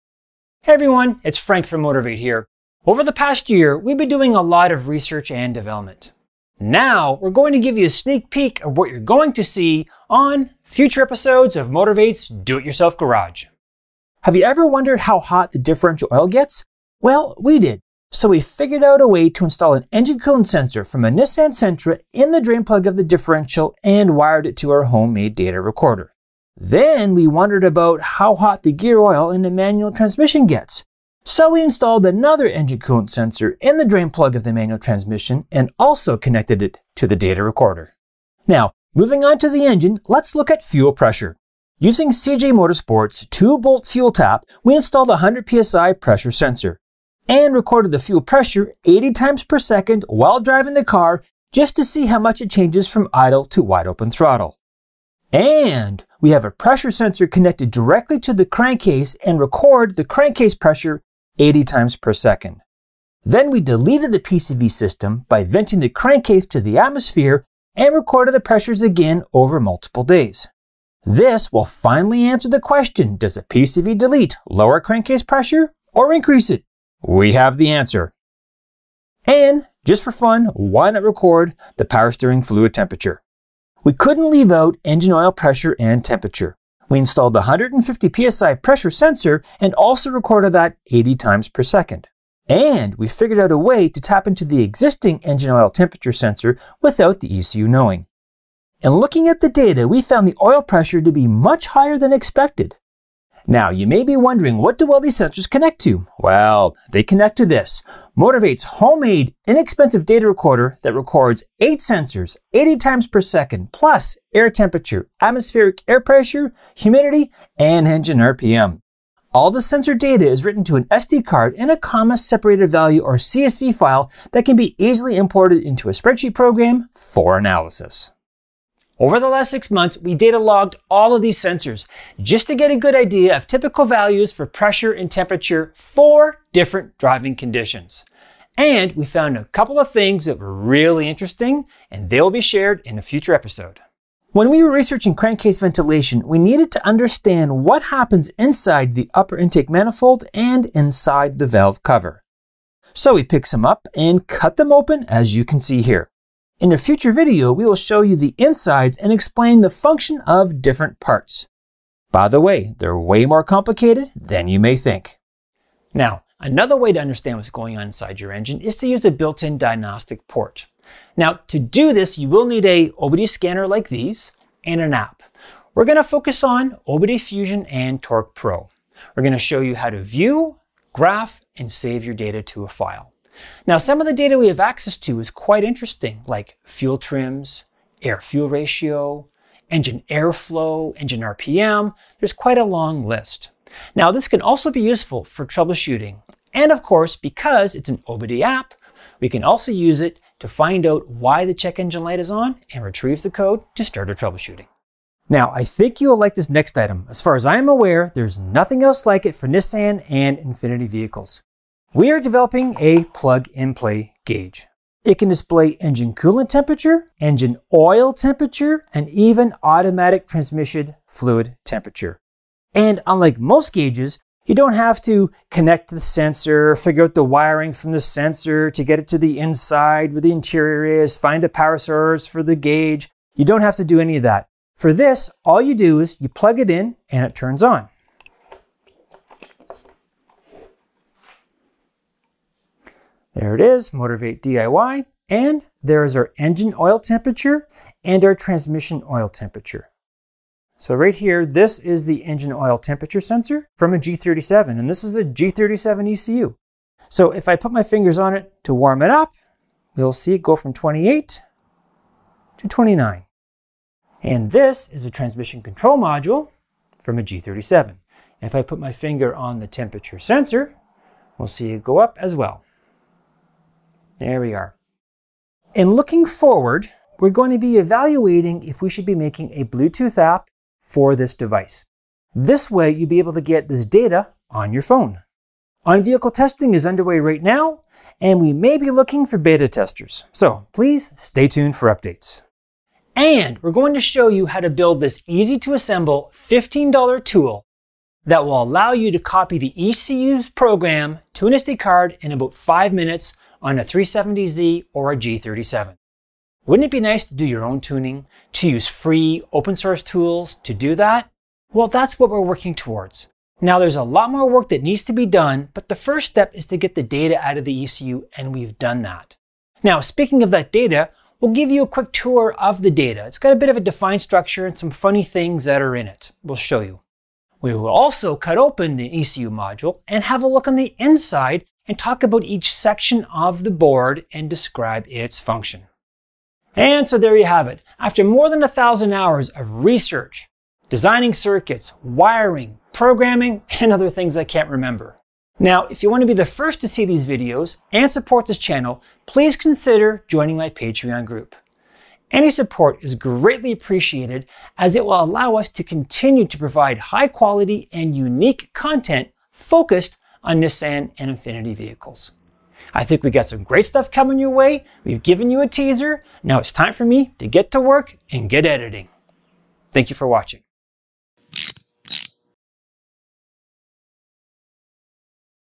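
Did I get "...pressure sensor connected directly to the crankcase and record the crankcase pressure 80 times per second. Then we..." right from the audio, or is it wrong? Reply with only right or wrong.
right.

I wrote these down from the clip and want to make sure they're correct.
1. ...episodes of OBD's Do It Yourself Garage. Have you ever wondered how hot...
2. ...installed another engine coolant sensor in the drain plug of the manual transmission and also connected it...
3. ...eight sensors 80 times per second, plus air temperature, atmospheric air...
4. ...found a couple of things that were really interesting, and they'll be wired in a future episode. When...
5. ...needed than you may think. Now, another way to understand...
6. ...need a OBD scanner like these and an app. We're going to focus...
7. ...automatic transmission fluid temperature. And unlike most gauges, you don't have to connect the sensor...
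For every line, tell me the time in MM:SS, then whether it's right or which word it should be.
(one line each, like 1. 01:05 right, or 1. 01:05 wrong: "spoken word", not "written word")
1. 00:11 wrong: "Motorvate", not "OBD"
2. 00:31 right
3. 01:51 right
4. 02:19 wrong: "shared", not "wired"
5. 02:43 wrong: "complicated", not "needed"
6. 02:52 right
7. 03:39 right.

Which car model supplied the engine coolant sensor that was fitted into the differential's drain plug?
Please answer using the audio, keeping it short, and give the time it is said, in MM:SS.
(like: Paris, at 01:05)
Nissan Sentra, at 00:21.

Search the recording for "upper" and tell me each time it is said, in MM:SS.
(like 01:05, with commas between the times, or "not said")
02:29.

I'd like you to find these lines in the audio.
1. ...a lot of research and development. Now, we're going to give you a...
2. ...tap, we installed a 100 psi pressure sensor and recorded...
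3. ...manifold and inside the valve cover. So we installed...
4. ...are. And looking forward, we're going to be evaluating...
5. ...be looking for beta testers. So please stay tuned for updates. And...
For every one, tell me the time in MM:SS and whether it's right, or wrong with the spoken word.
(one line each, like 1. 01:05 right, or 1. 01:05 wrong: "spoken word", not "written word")
1. 00:04 right
2. 00:44 right
3. 02:29 wrong: "picked", not "installed"
4. 04:34 right
5. 04:48 right.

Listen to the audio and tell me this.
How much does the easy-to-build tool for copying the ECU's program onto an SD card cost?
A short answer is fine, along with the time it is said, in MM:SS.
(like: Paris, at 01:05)
$15, at 04:56.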